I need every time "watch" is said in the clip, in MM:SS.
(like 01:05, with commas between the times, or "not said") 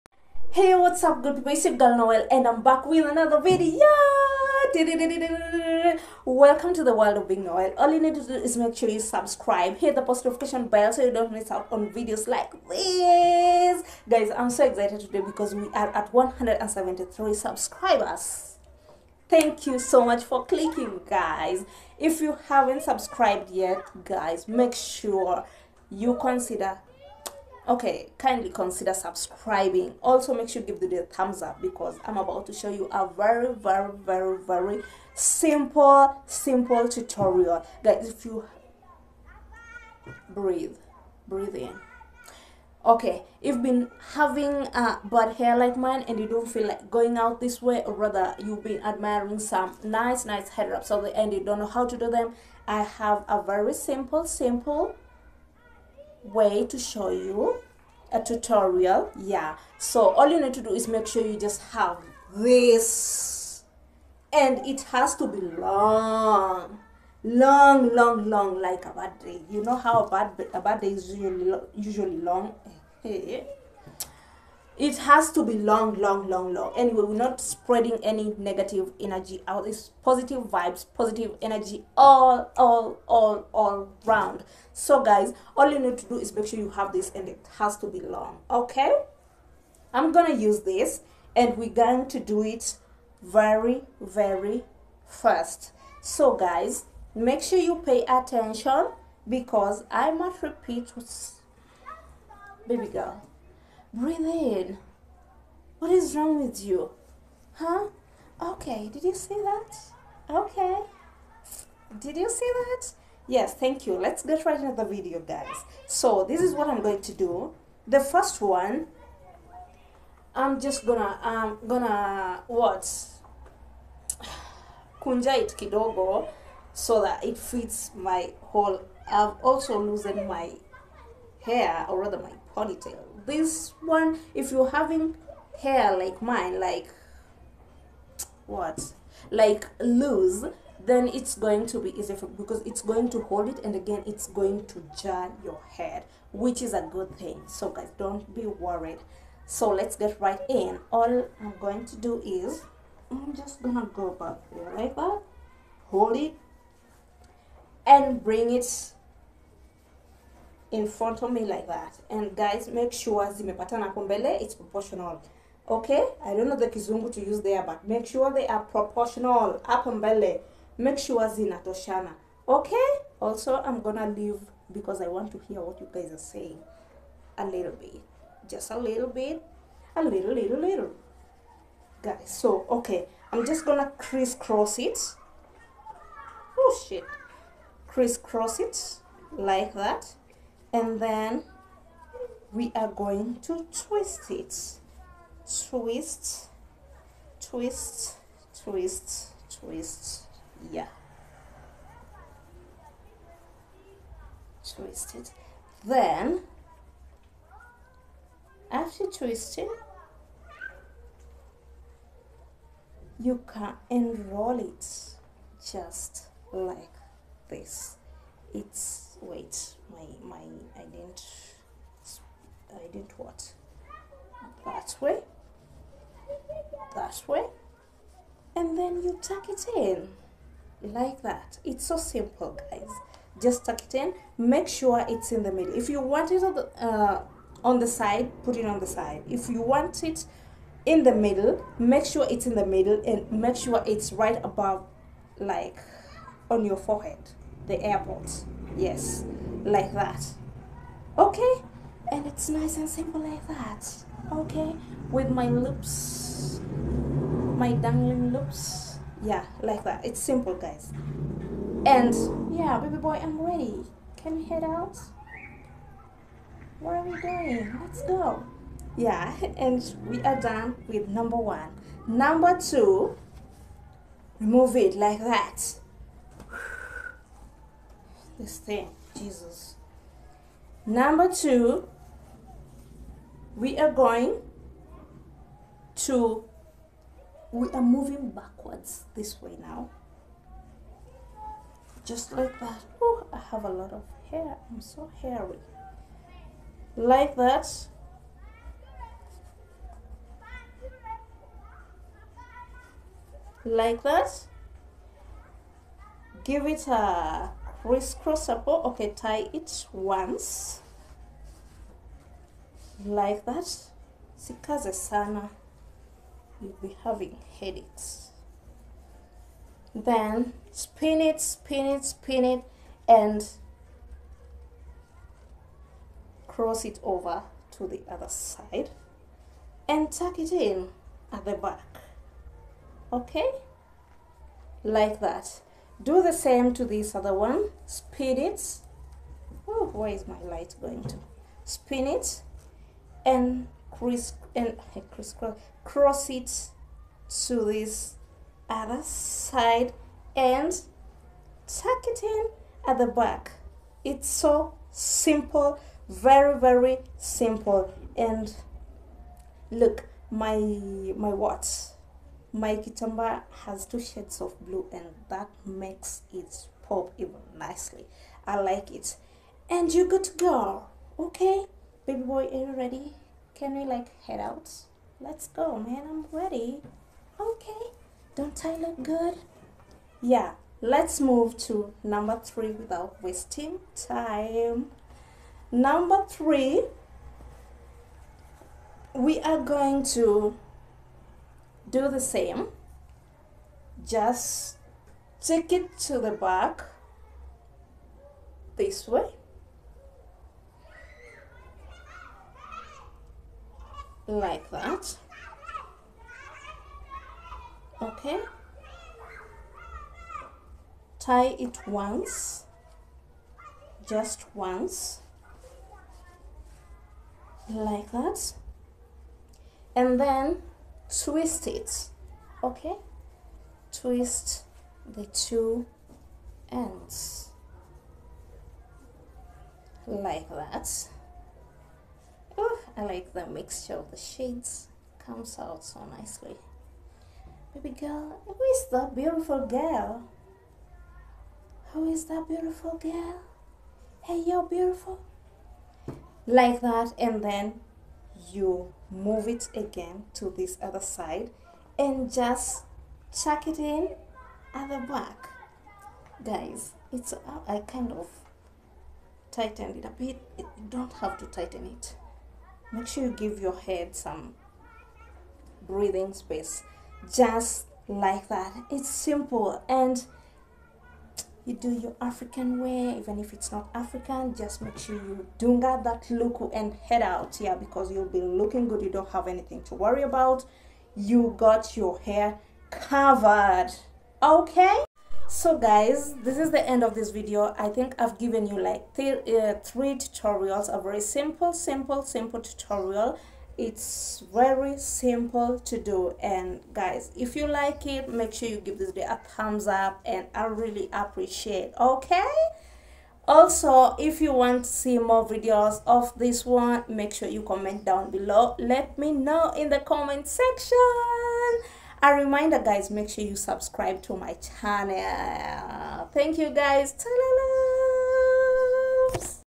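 06:01.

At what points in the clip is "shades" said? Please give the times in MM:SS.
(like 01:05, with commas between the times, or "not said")
06:03, 07:14.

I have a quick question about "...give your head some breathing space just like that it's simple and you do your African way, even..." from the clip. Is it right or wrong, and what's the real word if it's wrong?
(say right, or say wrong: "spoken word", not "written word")
right.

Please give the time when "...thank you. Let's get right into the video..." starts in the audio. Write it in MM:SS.
01:53.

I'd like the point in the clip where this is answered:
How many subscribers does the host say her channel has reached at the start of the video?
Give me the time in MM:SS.
00:16.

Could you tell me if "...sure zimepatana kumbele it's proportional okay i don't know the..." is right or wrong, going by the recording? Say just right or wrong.
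right.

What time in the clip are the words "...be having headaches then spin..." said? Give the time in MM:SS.
05:16.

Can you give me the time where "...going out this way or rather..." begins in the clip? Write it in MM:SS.
00:46.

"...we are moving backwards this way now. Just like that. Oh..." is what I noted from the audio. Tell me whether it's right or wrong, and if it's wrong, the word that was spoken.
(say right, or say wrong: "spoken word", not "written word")
right.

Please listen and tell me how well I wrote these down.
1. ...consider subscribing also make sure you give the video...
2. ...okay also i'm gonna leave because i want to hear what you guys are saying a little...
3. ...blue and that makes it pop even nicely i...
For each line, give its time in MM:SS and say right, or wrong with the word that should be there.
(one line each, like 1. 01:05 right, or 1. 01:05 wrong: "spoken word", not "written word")
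1. 00:28 right
2. 02:52 right
3. 06:04 right.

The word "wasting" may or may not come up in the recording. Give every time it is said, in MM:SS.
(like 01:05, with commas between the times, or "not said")
06:23.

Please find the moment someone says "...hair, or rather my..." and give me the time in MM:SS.
02:11.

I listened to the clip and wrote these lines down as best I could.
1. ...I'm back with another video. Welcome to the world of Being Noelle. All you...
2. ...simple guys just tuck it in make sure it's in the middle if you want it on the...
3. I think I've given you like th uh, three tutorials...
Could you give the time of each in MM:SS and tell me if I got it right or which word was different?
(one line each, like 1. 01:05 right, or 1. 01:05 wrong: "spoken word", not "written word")
1. 00:02 right
2. 03:51 right
3. 08:07 right.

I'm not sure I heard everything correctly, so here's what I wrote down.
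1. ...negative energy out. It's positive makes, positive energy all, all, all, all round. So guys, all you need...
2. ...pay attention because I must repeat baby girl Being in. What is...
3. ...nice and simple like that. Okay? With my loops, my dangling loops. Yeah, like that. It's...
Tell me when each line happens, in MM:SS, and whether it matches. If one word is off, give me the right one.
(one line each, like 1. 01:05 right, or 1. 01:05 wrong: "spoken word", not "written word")
1. 01:18 wrong: "vibes", not "makes"
2. 01:37 wrong: "Breathe", not "Being"
3. 04:12 right.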